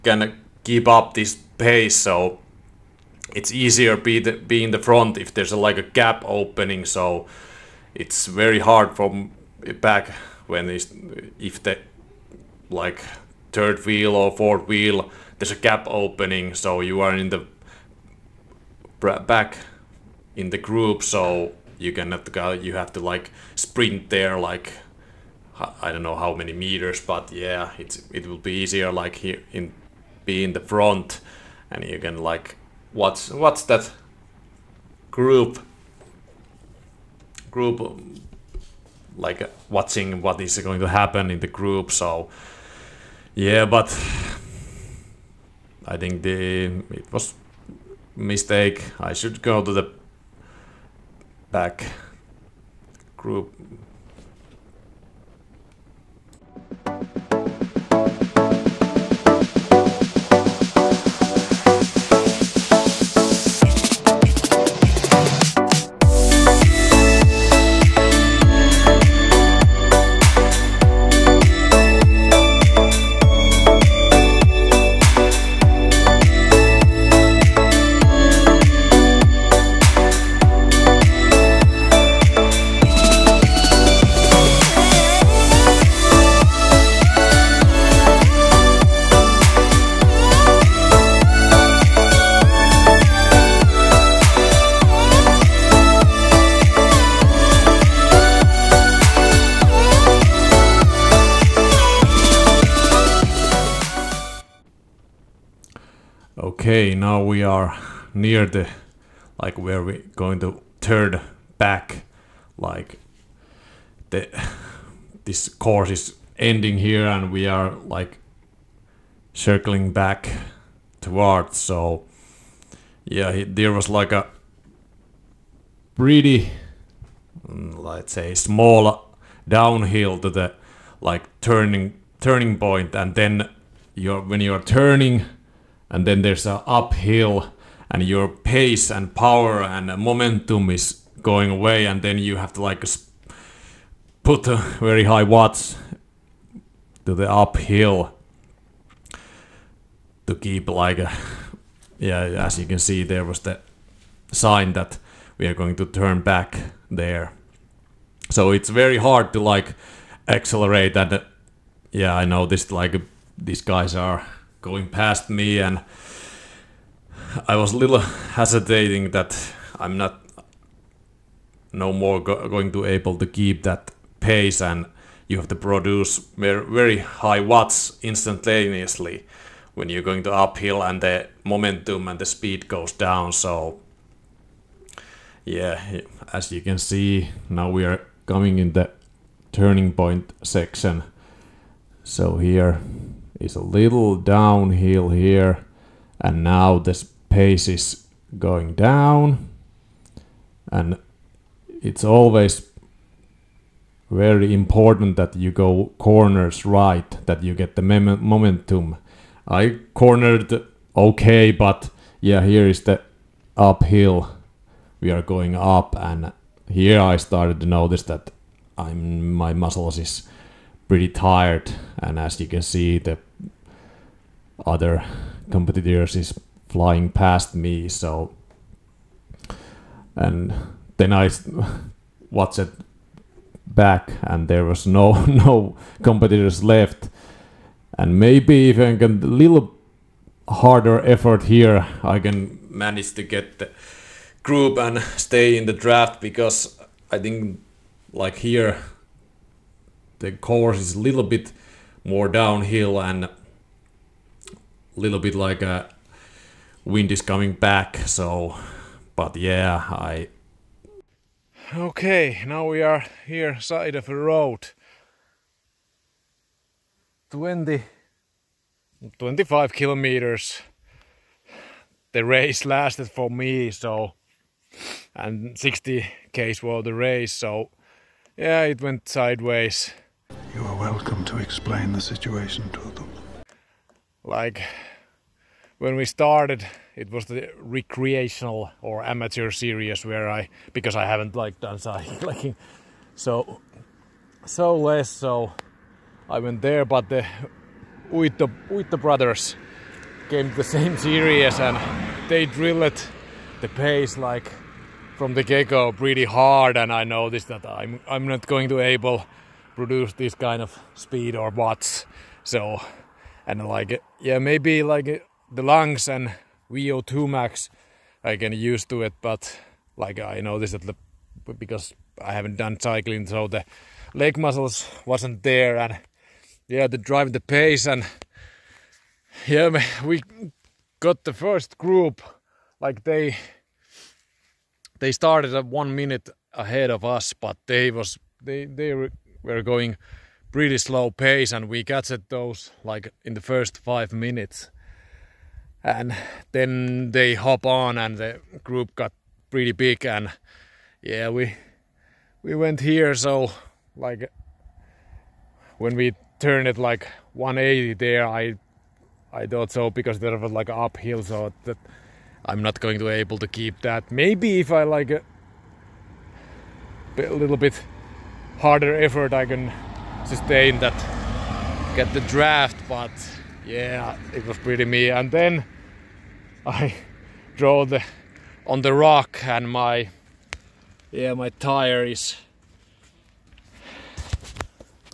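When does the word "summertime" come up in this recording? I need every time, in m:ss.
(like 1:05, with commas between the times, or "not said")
not said.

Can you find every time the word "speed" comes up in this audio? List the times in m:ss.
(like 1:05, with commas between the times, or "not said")
3:02, 5:10.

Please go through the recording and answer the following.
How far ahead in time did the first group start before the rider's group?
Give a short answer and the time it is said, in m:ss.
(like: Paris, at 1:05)
one minute, at 5:35.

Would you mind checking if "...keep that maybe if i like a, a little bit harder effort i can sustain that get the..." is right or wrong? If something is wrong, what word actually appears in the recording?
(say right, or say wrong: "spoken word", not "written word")
right.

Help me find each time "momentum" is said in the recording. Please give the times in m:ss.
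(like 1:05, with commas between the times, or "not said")
2:19, 3:01, 3:27.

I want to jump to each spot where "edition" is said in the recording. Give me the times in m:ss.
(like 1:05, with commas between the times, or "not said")
not said.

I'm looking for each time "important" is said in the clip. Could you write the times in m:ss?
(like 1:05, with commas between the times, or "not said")
3:24.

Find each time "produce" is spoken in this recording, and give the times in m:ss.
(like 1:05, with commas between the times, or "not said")
2:55, 5:09.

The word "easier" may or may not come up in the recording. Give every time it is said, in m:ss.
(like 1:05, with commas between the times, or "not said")
0:03, 0:28.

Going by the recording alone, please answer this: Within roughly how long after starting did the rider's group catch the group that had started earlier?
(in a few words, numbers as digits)
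first five minutes.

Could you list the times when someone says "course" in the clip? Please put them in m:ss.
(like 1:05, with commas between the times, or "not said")
1:55, 4:10.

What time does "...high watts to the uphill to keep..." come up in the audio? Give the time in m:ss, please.
2:25.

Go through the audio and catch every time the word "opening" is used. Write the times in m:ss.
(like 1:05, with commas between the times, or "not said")
0:06, 0:15.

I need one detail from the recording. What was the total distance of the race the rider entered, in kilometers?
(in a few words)
60.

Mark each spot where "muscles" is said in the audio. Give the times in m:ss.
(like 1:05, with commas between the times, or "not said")
3:39, 5:24.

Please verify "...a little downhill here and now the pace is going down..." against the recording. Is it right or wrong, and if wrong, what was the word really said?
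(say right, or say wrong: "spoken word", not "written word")
right.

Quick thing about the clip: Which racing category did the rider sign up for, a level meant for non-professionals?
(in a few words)
recreational or amateur series.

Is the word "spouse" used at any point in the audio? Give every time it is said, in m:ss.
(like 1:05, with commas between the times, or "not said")
not said.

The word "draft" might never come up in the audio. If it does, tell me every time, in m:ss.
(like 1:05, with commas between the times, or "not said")
4:05, 6:12.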